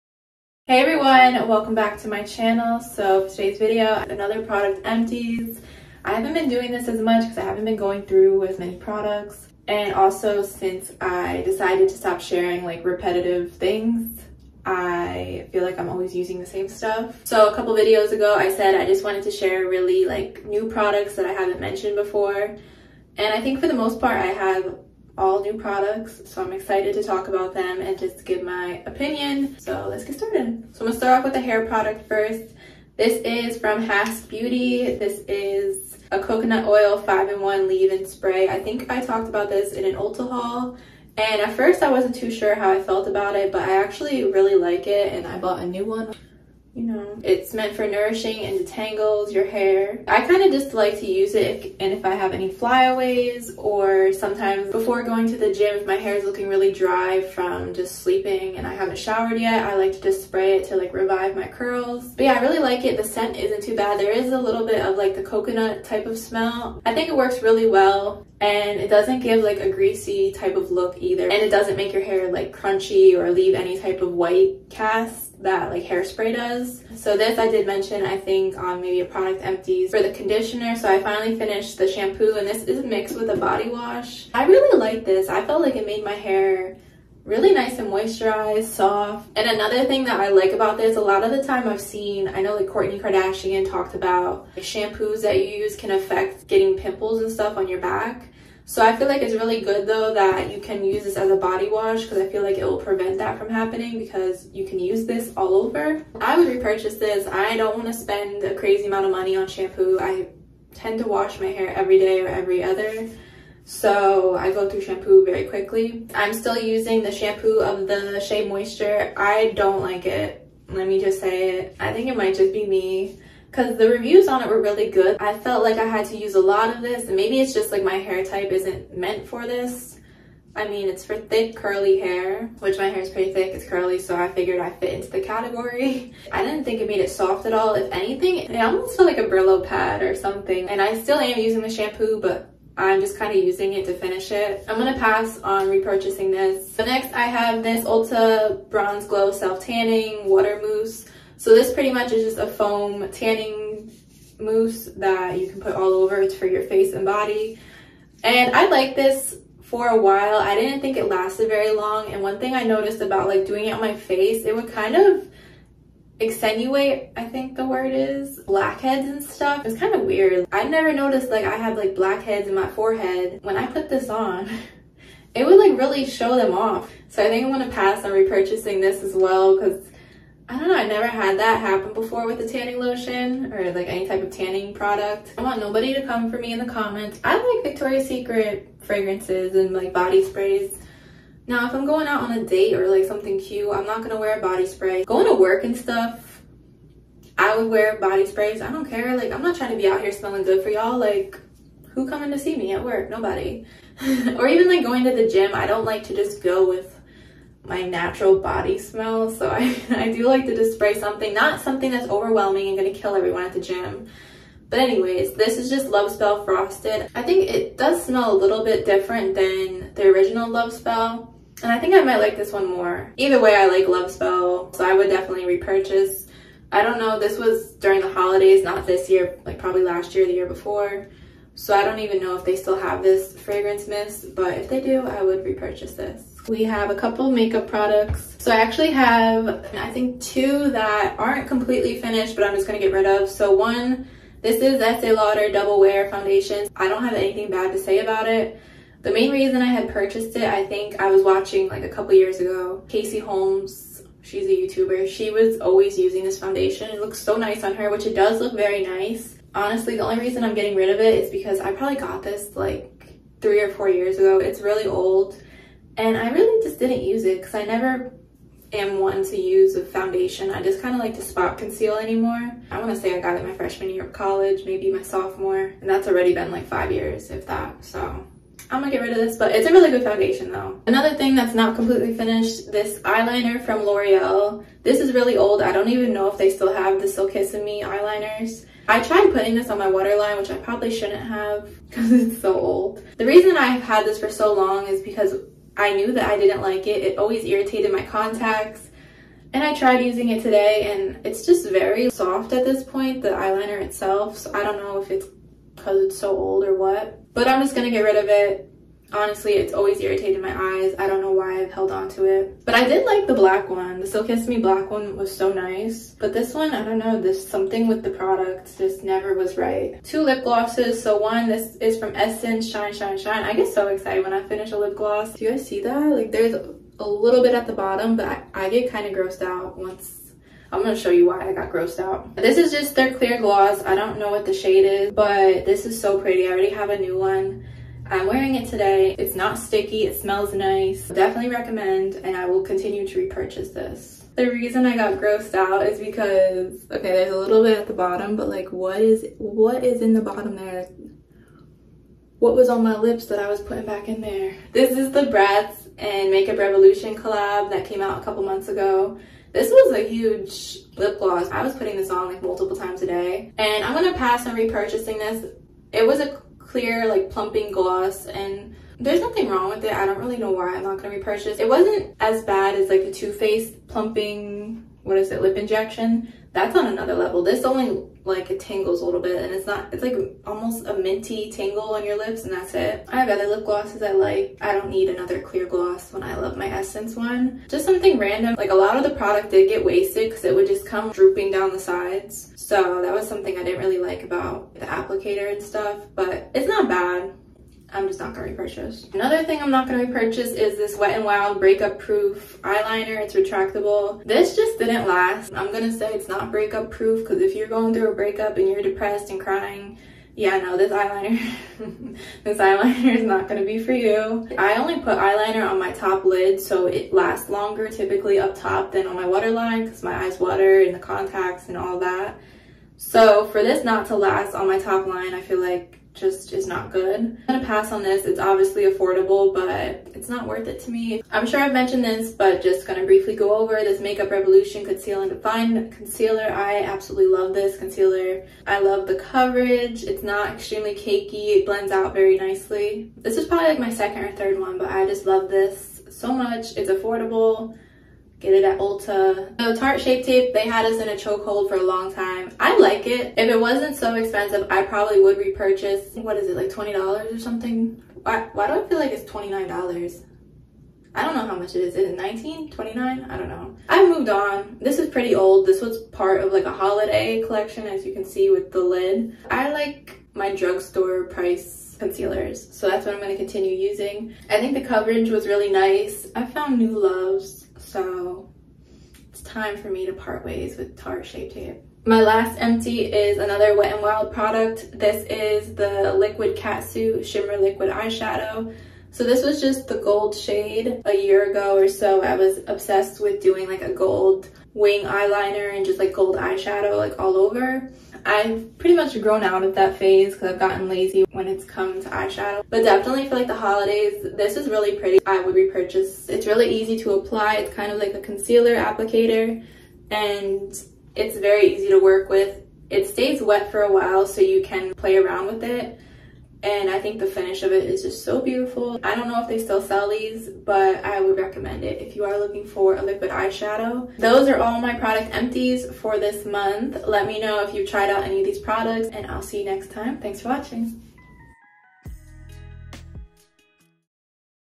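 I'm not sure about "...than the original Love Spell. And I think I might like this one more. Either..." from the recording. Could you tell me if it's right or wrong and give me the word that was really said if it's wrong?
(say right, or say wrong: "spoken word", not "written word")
right.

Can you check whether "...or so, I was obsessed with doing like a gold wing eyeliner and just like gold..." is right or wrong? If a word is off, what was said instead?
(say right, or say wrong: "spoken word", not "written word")
right.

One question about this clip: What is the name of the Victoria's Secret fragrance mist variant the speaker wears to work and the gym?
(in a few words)
Love Spell Frosted.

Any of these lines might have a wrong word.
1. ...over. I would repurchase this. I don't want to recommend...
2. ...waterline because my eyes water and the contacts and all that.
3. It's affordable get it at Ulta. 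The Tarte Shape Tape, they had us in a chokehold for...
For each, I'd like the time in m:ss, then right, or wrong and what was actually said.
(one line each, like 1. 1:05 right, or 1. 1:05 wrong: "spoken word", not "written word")
1. 1:45 wrong: "spend", not "recommend"
2. 6:59 right
3. 7:26 right.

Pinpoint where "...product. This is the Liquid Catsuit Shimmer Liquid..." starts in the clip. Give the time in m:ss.
8:04.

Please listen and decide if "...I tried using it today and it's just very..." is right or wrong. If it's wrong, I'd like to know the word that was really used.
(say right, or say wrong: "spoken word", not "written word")
right.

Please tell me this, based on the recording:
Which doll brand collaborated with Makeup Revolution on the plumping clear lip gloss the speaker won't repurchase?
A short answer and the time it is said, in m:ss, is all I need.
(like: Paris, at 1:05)
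Bratz, at 5:55.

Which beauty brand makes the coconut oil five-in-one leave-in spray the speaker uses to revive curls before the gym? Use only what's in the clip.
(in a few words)
Hask Beauty.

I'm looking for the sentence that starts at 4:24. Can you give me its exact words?
It's really old and I really just didn't use it because I never am one to use a foundation.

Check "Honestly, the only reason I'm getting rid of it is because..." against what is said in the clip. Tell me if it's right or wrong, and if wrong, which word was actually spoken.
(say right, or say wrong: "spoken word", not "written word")
right.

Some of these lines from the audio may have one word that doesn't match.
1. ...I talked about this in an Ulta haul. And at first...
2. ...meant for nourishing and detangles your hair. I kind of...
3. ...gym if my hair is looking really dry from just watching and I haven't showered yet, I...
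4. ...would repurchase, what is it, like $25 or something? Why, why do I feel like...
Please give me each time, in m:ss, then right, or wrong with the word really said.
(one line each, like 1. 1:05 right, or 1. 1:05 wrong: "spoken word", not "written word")
1. 0:38 right
2. 0:47 right
3. 0:55 wrong: "sleeping", not "watching"
4. 7:35 wrong: "20", not "25".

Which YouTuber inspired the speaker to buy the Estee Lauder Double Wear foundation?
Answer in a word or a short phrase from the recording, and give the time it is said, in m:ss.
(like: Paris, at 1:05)
Casey Holmes, at 4:12.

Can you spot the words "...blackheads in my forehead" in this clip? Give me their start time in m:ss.
2:51.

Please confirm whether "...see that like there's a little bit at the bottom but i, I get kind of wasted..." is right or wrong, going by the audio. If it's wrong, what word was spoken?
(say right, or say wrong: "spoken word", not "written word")
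wrong: "grossed", not "wasted".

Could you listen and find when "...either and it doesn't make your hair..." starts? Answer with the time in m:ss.
1:10.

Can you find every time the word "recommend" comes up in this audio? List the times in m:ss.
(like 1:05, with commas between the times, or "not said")
5:41, 8:41.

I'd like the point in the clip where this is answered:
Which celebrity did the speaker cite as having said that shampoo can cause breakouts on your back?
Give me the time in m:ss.
1:32.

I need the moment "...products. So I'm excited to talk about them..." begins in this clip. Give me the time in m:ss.
0:25.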